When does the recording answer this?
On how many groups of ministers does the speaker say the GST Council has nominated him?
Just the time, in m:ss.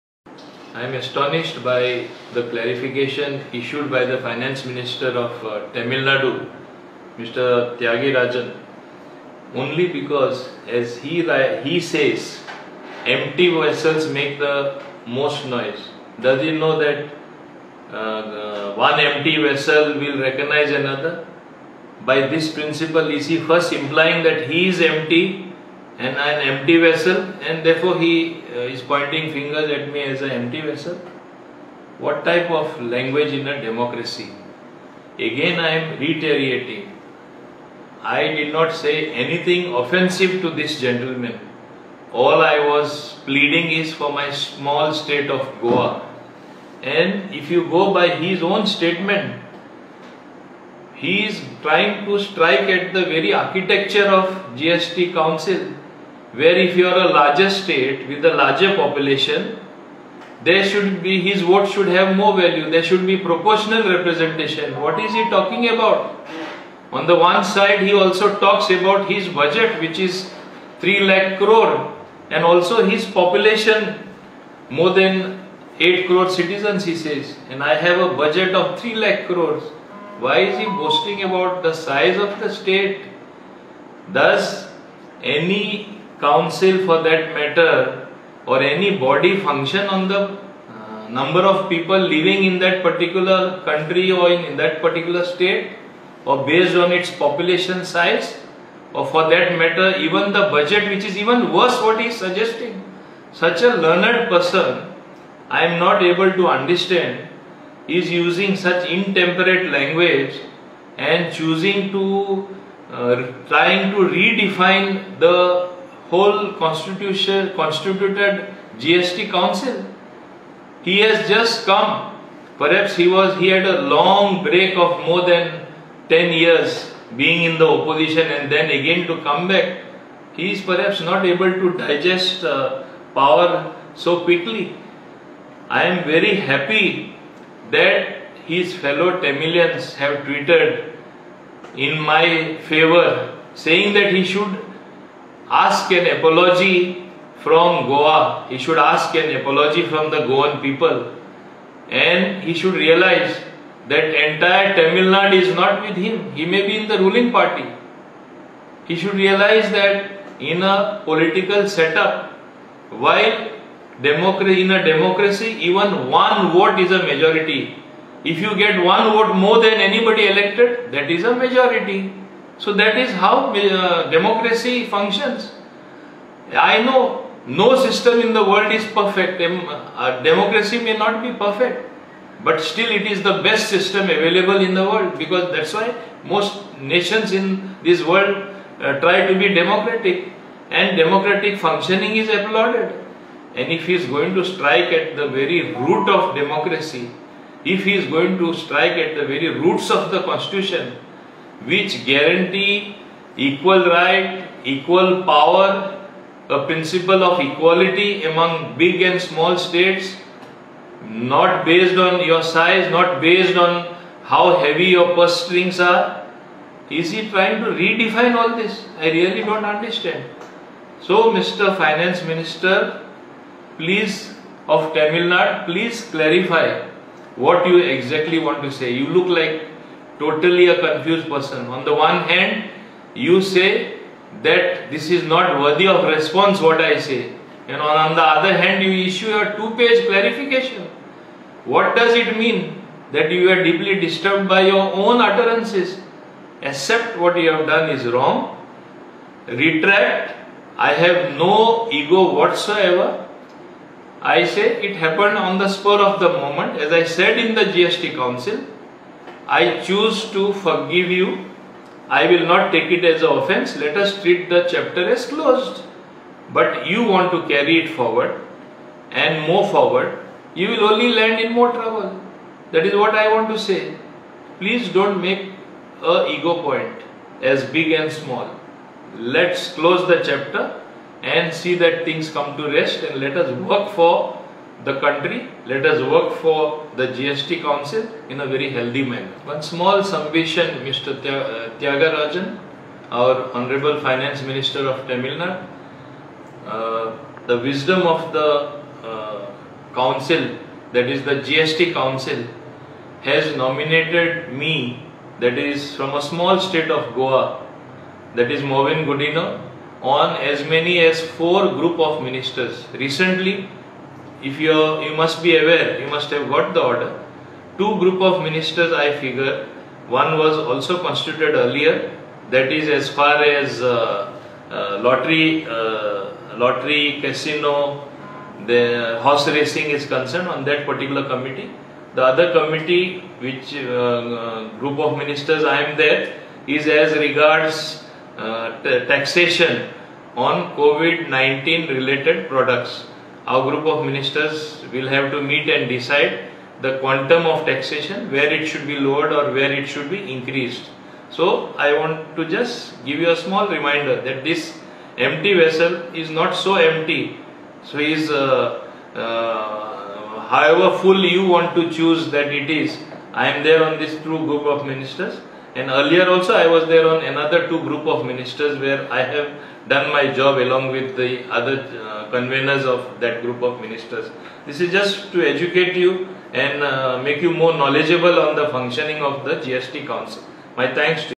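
5:11.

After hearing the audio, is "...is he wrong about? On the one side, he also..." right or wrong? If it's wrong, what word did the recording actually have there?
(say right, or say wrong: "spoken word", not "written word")
wrong: "talking", not "wrong".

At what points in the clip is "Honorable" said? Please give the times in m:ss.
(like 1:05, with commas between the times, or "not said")
4:53.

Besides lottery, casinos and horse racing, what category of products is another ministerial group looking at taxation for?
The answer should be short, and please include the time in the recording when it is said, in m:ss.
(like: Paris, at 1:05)
COVID-19 related products, at 5:40.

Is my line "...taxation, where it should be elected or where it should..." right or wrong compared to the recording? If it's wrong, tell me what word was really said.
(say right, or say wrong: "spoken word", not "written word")
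wrong: "lowered", not "elected".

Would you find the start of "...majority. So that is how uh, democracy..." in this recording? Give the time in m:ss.
2:51.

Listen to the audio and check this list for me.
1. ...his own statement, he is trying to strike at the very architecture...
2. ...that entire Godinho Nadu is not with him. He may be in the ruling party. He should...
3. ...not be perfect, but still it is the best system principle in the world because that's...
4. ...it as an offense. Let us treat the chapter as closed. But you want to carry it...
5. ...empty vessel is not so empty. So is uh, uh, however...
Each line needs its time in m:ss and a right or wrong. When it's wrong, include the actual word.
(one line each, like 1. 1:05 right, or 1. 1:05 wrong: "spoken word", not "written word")
1. 0:48 right
2. 2:33 wrong: "Tamil", not "Godinho"
3. 3:00 wrong: "available", not "principle"
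4. 4:22 right
5. 5:55 right.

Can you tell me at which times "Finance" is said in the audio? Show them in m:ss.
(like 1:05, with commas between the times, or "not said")
0:04, 3:41, 4:54.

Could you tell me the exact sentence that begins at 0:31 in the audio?
What type of language in a democracy?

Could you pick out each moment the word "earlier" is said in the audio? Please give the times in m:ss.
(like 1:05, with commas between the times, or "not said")
5:21, 6:05.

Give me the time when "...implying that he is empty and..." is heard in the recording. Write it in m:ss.
0:23.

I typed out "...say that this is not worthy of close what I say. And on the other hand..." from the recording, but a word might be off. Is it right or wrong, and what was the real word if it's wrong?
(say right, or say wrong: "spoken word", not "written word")
wrong: "response", not "close".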